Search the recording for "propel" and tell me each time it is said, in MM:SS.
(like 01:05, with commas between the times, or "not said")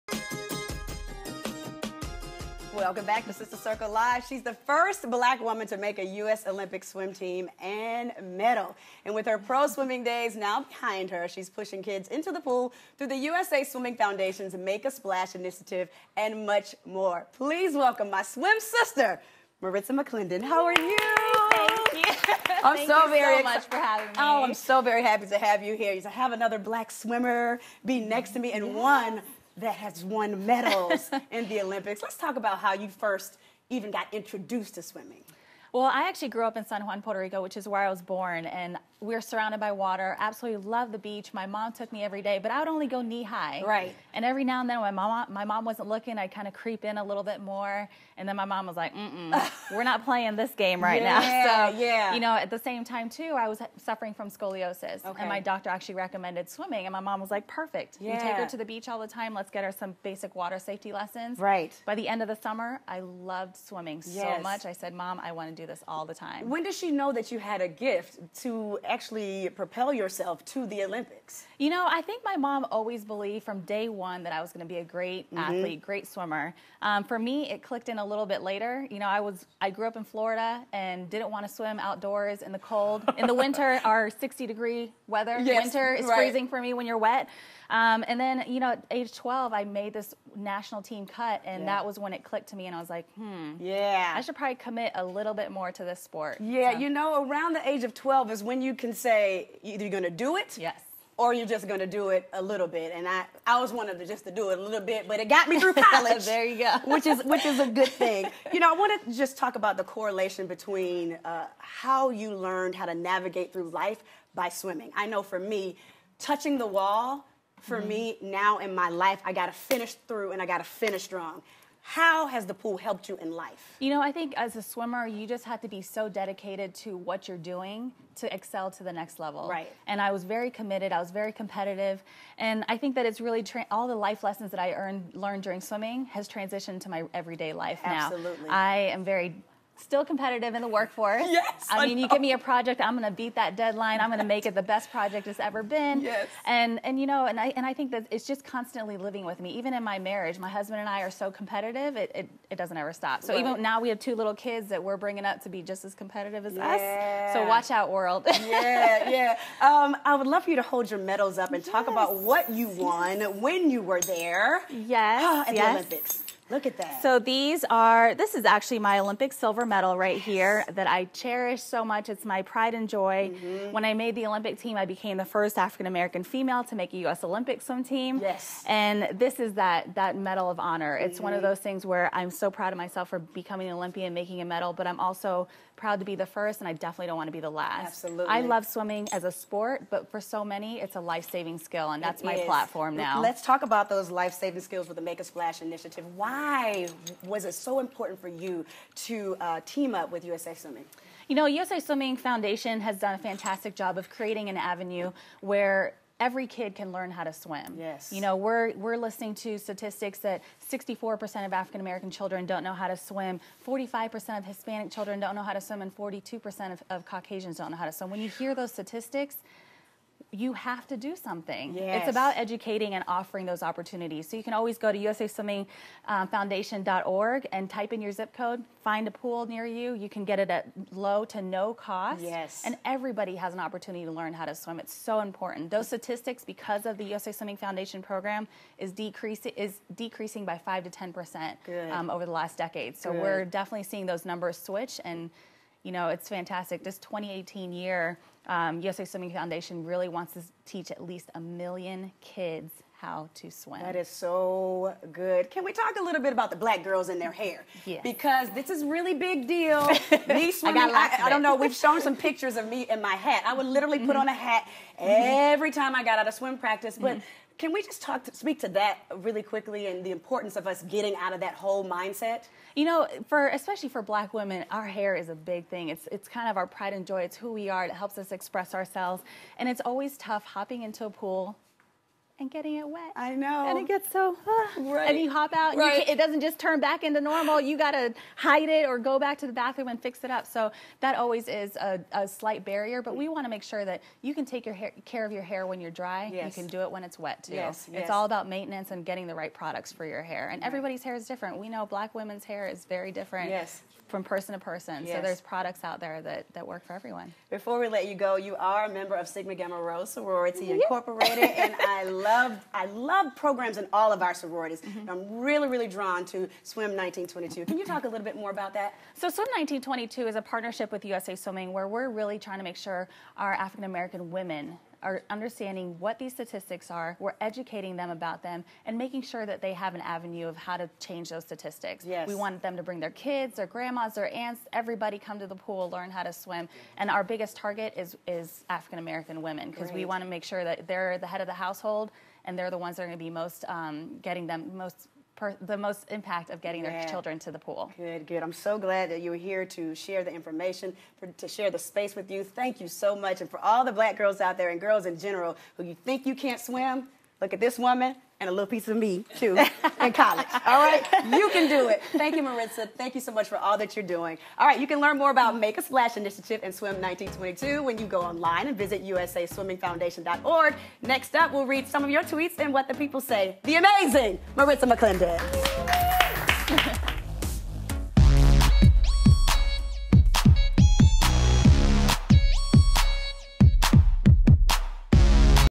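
01:09.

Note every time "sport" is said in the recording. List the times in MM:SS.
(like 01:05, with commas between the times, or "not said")
01:36, 03:09.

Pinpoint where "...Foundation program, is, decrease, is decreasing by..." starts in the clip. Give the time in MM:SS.
03:57.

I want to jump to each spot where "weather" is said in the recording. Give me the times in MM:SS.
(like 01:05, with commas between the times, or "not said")
01:25.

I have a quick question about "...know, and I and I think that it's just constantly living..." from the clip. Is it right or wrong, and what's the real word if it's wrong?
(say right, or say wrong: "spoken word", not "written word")
right.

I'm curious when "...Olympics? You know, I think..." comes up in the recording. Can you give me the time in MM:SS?
01:10.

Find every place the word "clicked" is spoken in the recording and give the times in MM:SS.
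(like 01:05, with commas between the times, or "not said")
01:17, 01:32.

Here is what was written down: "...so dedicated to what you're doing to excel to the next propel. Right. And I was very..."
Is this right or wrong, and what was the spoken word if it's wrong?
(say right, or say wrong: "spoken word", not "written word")
wrong: "level", not "propel".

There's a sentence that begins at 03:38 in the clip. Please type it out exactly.
When you hear those statistics, you have to do something.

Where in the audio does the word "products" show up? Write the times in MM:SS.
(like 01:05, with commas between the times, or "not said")
04:59, 05:05.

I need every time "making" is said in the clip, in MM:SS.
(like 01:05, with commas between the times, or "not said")
03:04, 05:28.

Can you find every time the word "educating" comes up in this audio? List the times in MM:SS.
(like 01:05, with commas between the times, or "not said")
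03:42, 05:27.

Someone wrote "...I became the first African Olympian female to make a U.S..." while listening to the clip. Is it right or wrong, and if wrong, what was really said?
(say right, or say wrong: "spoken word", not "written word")
wrong: "American", not "Olympian".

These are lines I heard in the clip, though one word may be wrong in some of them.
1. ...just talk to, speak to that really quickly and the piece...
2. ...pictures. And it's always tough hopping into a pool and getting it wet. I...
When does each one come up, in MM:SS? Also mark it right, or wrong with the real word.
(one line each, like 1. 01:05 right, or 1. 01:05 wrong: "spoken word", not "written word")
1. 04:27 wrong: "importance", not "piece"
2. 04:38 wrong: "ourselves", not "pictures".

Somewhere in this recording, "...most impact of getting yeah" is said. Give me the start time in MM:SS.
05:45.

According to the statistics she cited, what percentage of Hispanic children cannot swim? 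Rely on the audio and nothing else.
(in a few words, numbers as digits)
45%.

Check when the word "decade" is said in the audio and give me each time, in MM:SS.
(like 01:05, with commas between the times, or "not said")
04:02.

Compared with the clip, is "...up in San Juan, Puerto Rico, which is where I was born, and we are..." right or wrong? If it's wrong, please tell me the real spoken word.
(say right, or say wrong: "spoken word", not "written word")
right.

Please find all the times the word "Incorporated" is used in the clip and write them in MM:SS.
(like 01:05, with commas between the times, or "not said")
05:10.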